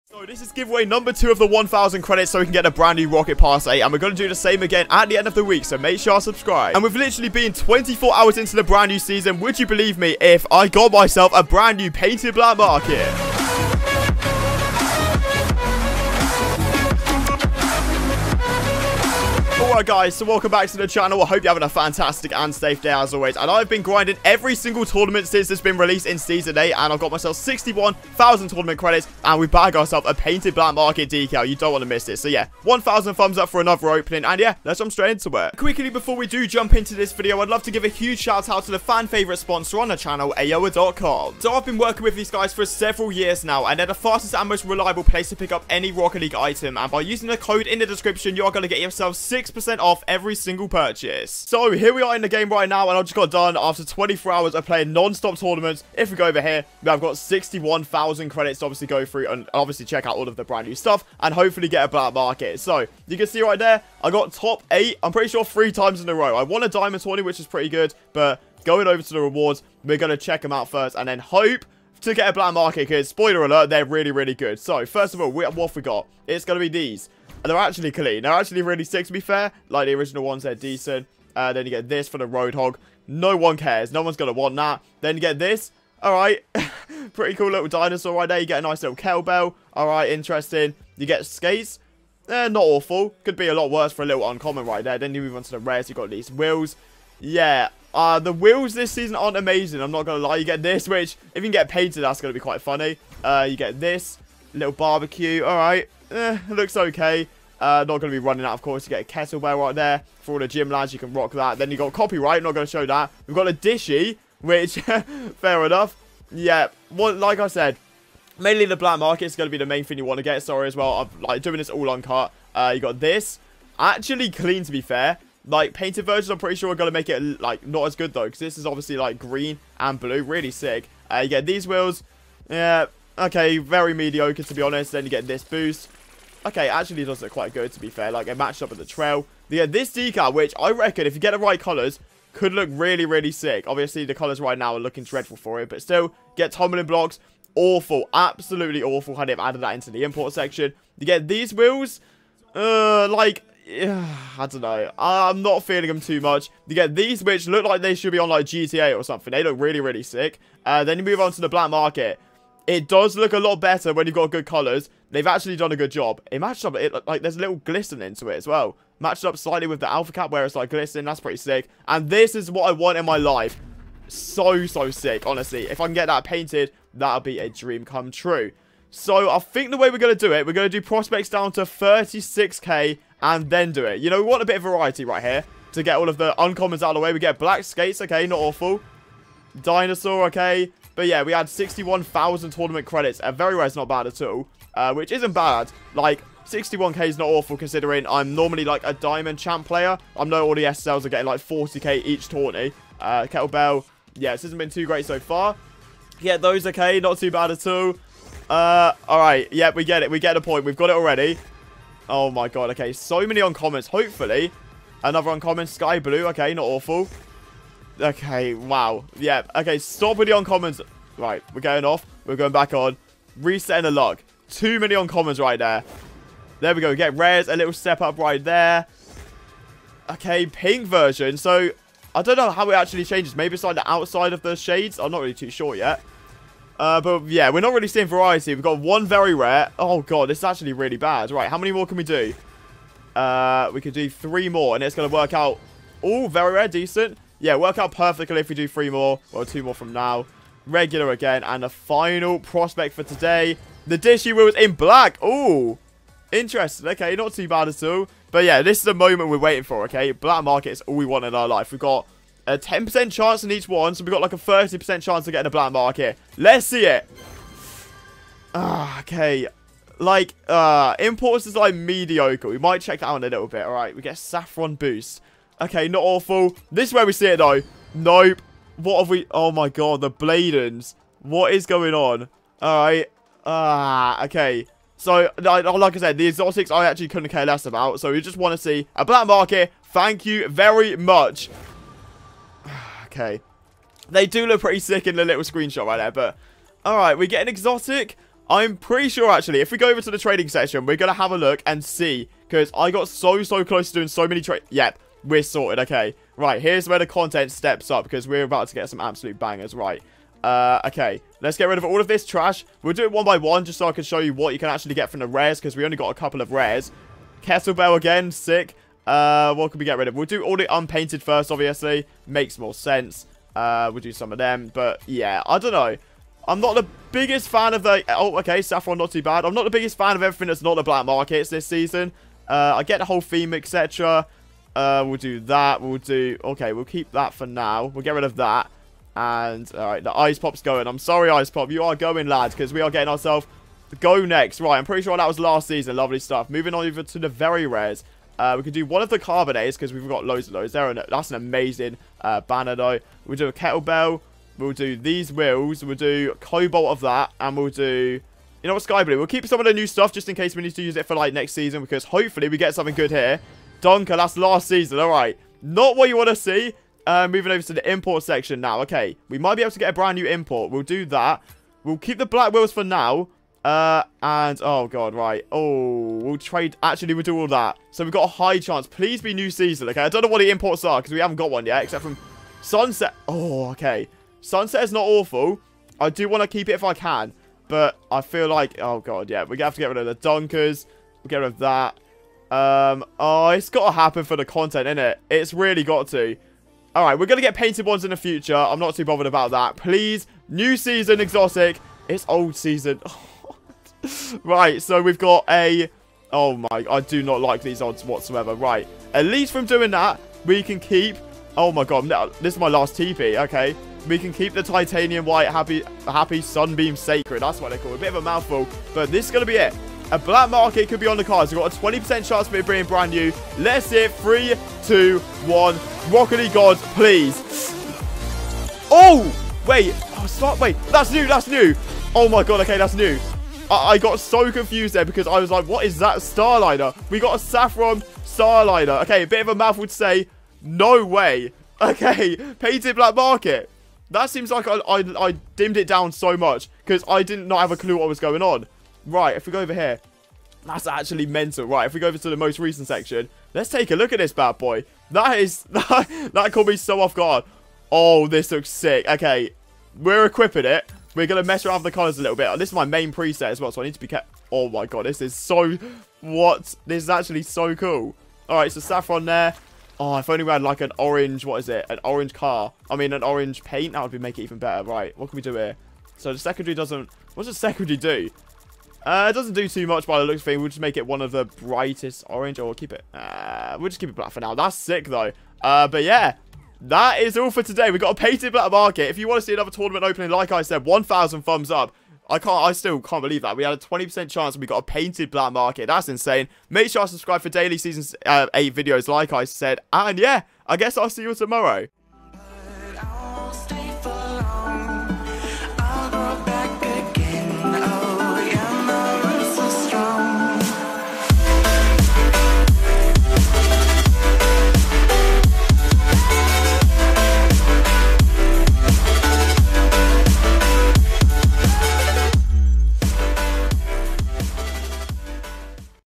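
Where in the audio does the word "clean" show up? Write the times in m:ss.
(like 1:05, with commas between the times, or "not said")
1:17, 2:04.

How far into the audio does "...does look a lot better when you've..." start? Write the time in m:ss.
2:42.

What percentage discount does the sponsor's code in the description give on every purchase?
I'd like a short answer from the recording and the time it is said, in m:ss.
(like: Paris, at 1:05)
6%, at 0:49.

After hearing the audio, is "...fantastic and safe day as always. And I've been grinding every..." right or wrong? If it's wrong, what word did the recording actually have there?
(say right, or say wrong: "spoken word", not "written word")
right.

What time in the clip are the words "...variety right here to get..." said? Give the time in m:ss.
3:04.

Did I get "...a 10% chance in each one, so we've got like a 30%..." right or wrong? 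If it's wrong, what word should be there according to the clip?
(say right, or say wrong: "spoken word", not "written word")
right.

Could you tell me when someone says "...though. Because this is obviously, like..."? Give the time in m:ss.
2:08.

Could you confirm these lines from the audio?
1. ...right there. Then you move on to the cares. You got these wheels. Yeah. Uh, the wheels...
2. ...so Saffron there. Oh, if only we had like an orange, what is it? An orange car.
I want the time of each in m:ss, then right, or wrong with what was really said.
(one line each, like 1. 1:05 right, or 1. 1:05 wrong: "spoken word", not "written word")
1. 1:34 wrong: "rares", not "cares"
2. 7:48 right.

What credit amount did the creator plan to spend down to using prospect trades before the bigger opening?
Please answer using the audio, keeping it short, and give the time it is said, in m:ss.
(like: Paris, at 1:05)
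36k, at 3:01.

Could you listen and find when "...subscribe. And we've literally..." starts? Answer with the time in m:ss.
0:06.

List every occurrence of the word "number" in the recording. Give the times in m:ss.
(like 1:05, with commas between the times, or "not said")
0:00.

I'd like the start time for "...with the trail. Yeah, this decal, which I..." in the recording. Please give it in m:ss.
2:18.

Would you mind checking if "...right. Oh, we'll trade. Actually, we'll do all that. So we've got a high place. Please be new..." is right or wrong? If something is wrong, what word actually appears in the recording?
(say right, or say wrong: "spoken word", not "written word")
wrong: "chance", not "place".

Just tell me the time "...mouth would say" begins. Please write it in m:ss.
7:19.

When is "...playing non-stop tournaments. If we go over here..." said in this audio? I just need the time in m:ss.
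0:54.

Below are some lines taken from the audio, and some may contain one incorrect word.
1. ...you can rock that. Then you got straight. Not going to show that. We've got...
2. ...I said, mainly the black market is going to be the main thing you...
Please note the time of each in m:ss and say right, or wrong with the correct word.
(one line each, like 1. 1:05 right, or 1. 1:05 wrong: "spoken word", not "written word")
1. 1:50 wrong: "copyright", not "straight"
2. 1:57 right.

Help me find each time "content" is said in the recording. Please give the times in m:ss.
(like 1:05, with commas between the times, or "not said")
5:07, 6:34.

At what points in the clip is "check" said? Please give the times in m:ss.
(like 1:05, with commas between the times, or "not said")
0:59, 1:10, 4:32.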